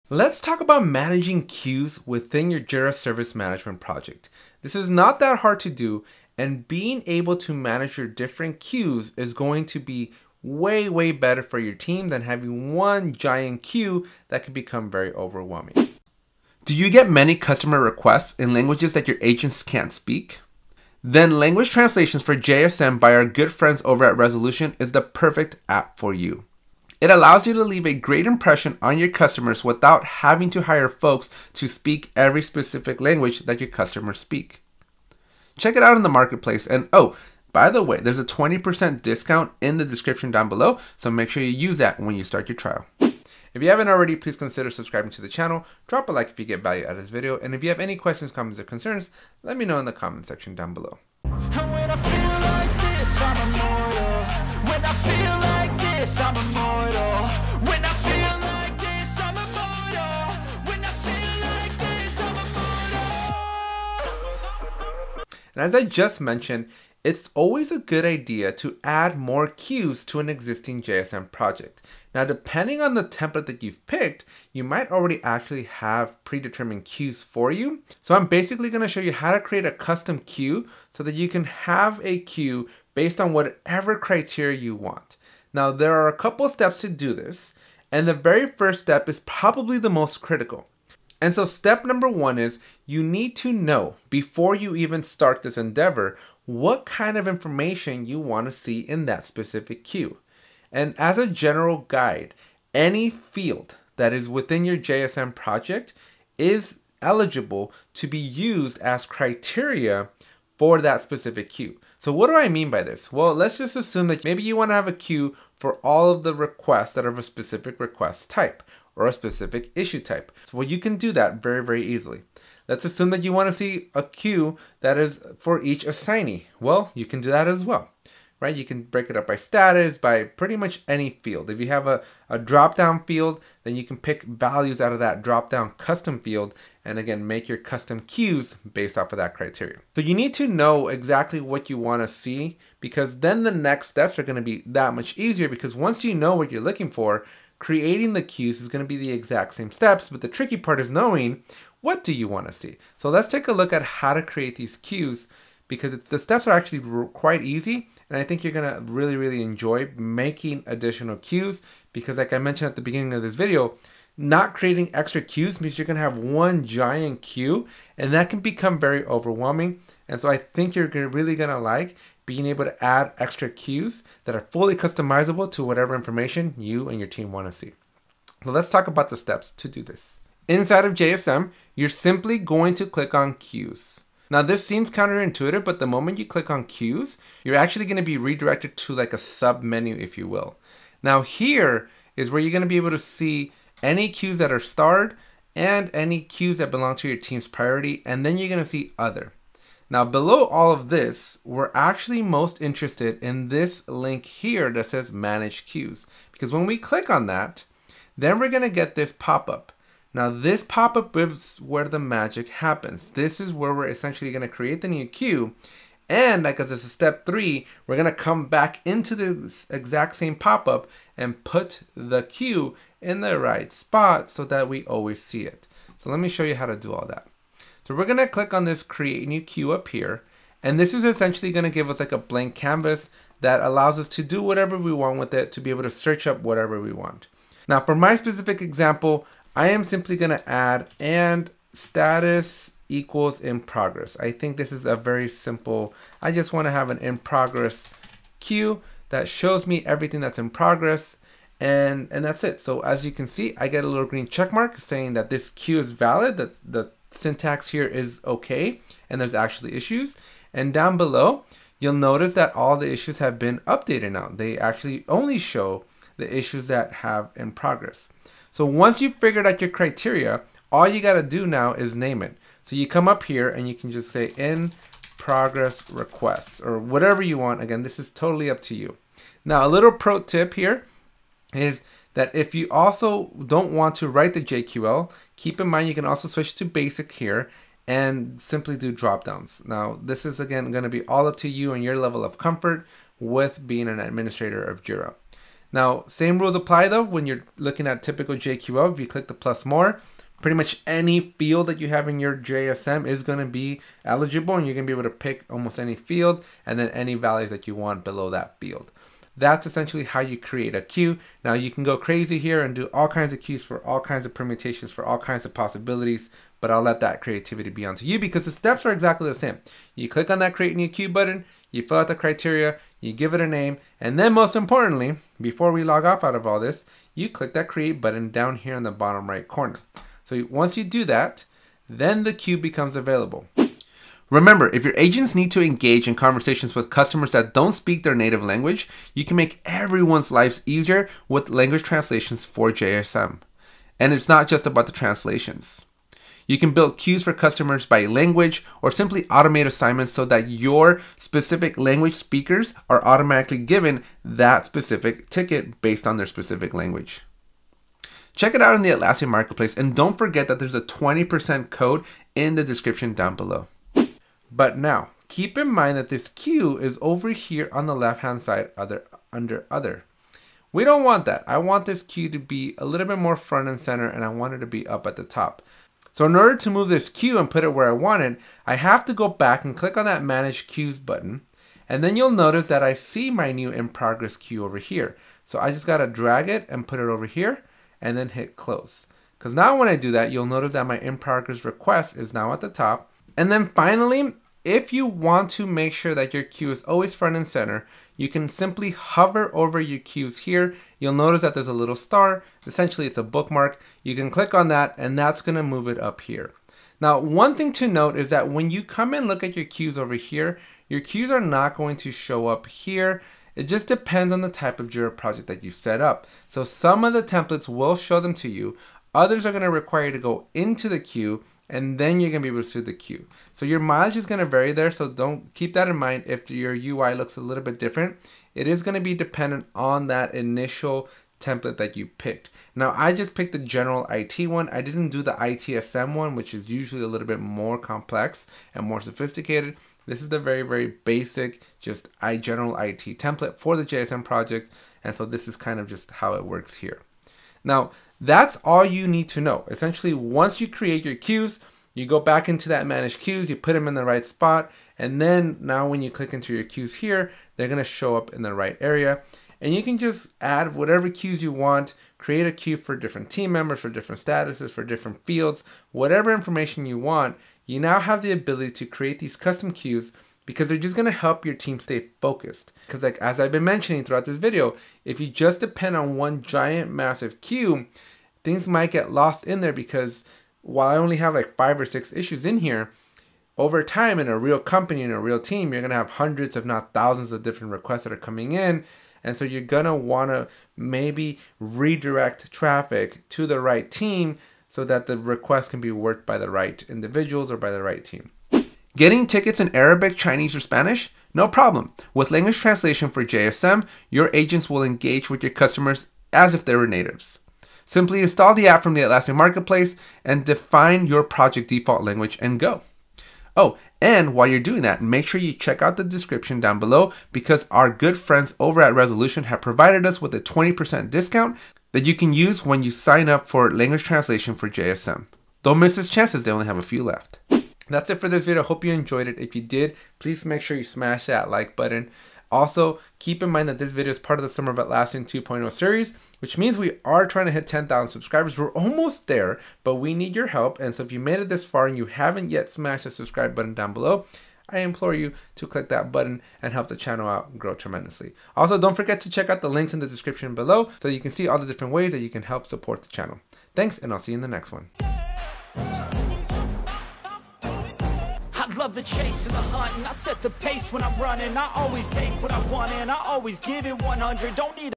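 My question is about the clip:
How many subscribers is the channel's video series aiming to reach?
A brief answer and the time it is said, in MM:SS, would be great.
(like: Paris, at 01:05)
10,000, at 08:57.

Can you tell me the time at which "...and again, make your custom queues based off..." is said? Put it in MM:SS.
02:16.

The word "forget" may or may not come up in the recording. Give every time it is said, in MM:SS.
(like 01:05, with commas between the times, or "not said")
06:00, 09:08.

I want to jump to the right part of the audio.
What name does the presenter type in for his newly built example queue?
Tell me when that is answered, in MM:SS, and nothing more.
04:34.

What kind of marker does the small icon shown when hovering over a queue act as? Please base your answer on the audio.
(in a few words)
A bookmark.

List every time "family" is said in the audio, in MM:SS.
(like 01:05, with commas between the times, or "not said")
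not said.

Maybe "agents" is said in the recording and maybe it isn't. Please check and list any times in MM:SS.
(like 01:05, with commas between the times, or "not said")
00:19, 05:34, 08:24.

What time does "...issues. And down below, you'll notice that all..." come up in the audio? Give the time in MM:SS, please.
04:19.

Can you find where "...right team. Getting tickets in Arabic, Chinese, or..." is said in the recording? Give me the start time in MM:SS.
08:17.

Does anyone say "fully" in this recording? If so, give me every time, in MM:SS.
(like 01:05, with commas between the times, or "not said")
02:54.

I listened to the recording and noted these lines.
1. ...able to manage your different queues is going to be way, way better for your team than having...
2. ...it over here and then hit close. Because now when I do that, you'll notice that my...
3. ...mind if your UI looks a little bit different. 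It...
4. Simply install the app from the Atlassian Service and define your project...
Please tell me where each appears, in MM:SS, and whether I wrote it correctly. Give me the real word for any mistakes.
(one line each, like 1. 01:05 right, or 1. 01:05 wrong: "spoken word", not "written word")
1. 00:07 right
2. 06:26 right
3. 07:05 right
4. 08:27 wrong: "Marketplace", not "Service".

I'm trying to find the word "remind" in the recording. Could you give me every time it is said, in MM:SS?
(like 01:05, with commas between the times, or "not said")
not said.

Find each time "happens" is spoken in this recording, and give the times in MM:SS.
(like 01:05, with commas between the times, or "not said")
03:32.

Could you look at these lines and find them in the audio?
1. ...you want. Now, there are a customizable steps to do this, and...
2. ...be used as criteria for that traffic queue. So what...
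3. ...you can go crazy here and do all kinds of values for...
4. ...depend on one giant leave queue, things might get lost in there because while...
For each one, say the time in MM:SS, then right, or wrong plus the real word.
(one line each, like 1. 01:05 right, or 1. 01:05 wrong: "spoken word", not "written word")
1. 01:24 wrong: "couple", not "customizable"
2. 01:48 wrong: "specific", not "traffic"
3. 05:11 wrong: "queues", not "values"
4. 07:55 wrong: "massive", not "leave".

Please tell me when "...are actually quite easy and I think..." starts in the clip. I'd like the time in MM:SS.
02:36.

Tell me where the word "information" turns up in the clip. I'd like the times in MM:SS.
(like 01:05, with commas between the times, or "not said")
01:37, 02:55, 07:46.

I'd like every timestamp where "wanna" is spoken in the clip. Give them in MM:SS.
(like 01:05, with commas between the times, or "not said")
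02:57, 04:06, 08:09.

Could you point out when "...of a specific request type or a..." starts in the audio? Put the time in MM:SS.
01:57.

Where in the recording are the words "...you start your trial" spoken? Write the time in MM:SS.
00:42.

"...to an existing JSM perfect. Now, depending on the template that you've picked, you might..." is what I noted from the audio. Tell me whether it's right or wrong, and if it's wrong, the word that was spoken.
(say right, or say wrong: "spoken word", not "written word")
wrong: "project", not "perfect".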